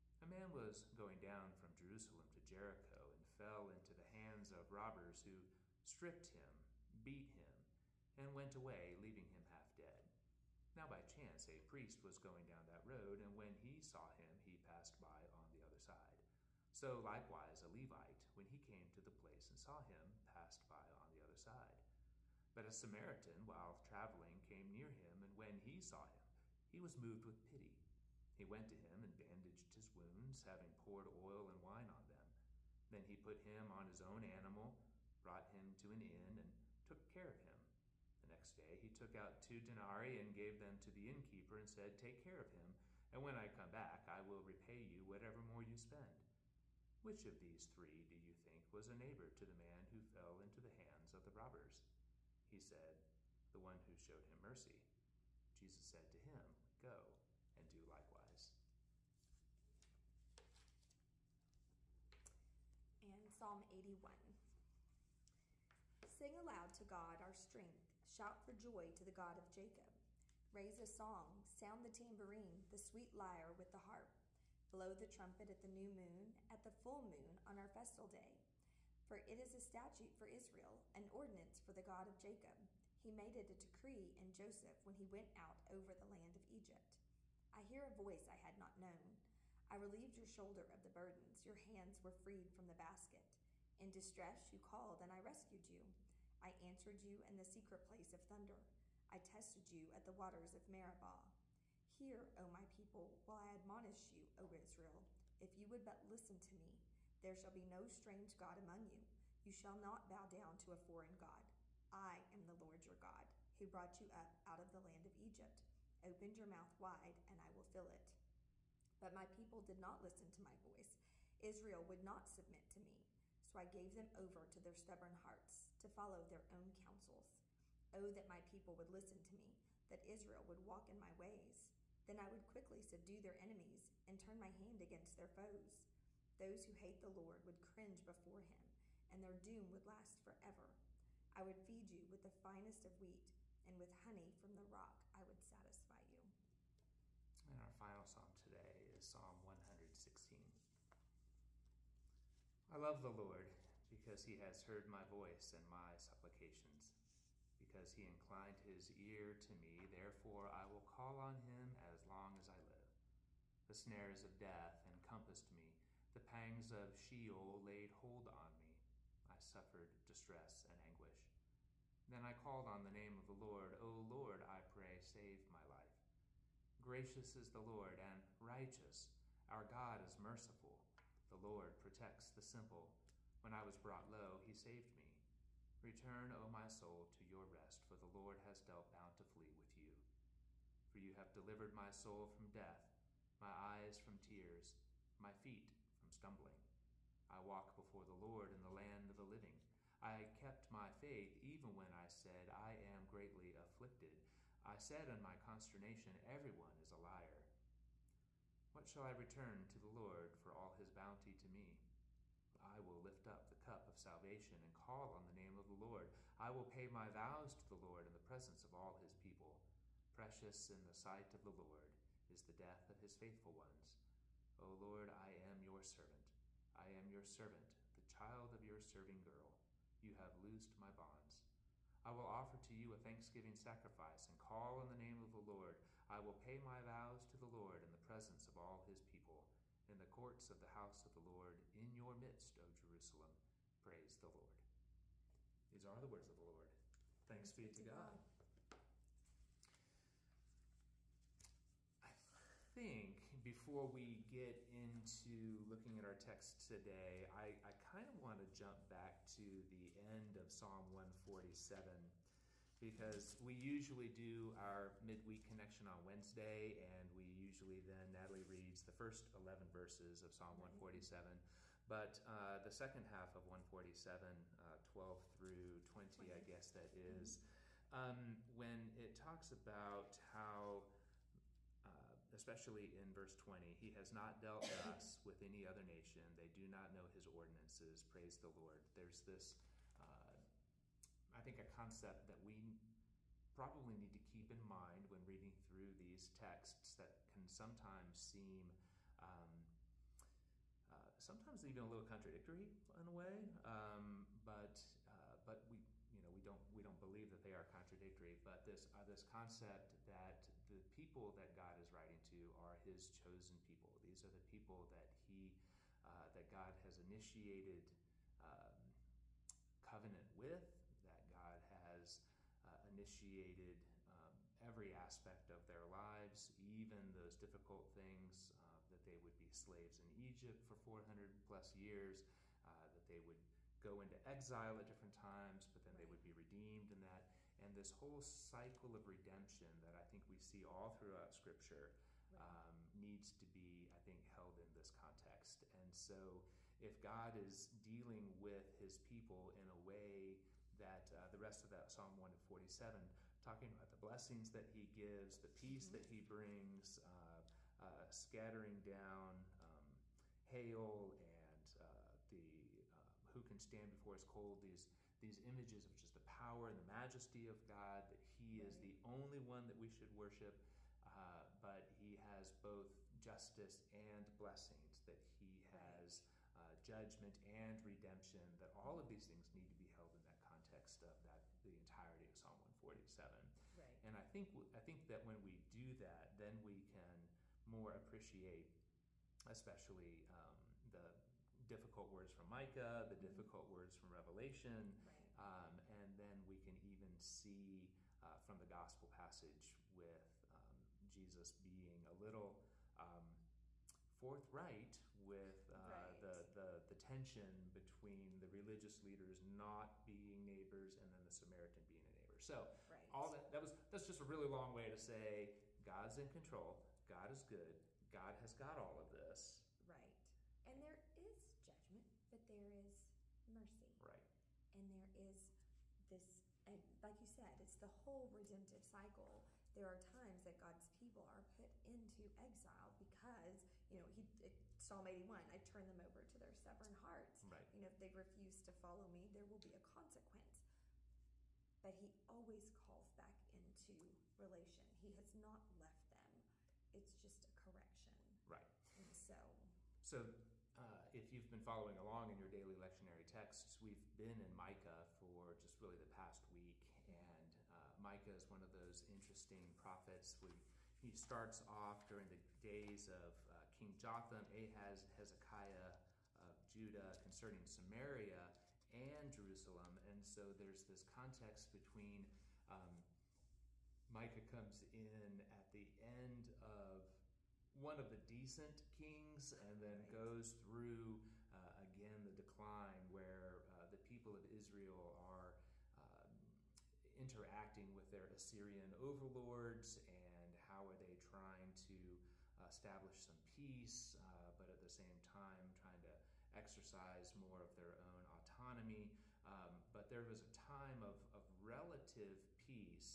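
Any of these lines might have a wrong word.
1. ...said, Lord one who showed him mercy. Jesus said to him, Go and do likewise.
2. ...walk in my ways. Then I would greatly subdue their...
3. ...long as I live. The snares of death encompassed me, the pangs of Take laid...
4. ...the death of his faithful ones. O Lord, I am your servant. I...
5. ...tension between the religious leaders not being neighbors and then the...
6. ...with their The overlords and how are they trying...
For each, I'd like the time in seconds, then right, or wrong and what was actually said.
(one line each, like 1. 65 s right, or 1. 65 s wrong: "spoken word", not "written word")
1. 52 s wrong: "The", not "Lord"
2. 130 s wrong: "quickly", not "greatly"
3. 162 s wrong: "Sheol", not "Take"
4. 222 s right
5. 406 s right
6. 487 s wrong: "Assyrian", not "The".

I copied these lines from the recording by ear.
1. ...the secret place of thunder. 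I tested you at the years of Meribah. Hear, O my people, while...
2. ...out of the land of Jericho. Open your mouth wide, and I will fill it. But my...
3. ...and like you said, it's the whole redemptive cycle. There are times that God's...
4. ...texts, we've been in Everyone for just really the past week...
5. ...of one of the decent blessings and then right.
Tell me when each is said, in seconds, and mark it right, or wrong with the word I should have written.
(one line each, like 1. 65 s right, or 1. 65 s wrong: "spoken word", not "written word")
1. 97 s wrong: "waters", not "years"
2. 114 s wrong: "Egypt", not "Jericho"
3. 426 s right
4. 453 s wrong: "Micah", not "Everyone"
5. 476 s wrong: "kings", not "blessings".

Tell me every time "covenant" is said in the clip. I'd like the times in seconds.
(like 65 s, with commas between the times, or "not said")
319 s.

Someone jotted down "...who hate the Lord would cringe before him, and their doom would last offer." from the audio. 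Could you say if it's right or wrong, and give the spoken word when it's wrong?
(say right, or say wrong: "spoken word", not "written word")
wrong: "forever", not "offer".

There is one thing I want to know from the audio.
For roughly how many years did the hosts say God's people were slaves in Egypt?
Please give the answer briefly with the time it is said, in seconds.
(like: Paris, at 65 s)
400 plus years, at 330 s.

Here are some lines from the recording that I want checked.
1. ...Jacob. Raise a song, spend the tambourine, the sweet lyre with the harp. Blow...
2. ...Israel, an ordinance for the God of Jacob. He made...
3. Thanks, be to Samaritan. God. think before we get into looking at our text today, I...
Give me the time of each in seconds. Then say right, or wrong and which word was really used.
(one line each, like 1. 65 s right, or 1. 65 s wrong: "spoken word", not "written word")
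1. 69 s wrong: "sound", not "spend"
2. 80 s right
3. 247 s wrong: "God", not "Samaritan".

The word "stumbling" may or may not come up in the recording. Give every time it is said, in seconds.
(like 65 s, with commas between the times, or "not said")
196 s.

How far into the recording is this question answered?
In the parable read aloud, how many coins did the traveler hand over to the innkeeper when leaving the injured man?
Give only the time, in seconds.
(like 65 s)
39 s.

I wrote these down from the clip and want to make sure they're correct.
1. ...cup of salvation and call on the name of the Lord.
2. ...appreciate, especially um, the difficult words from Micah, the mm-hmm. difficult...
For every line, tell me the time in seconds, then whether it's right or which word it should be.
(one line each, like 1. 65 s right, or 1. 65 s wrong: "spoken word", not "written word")
1. 213 s right
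2. 387 s right.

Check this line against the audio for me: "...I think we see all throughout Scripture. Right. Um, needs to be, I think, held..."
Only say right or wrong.
right.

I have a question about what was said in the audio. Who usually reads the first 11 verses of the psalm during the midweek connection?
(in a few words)
Natalie.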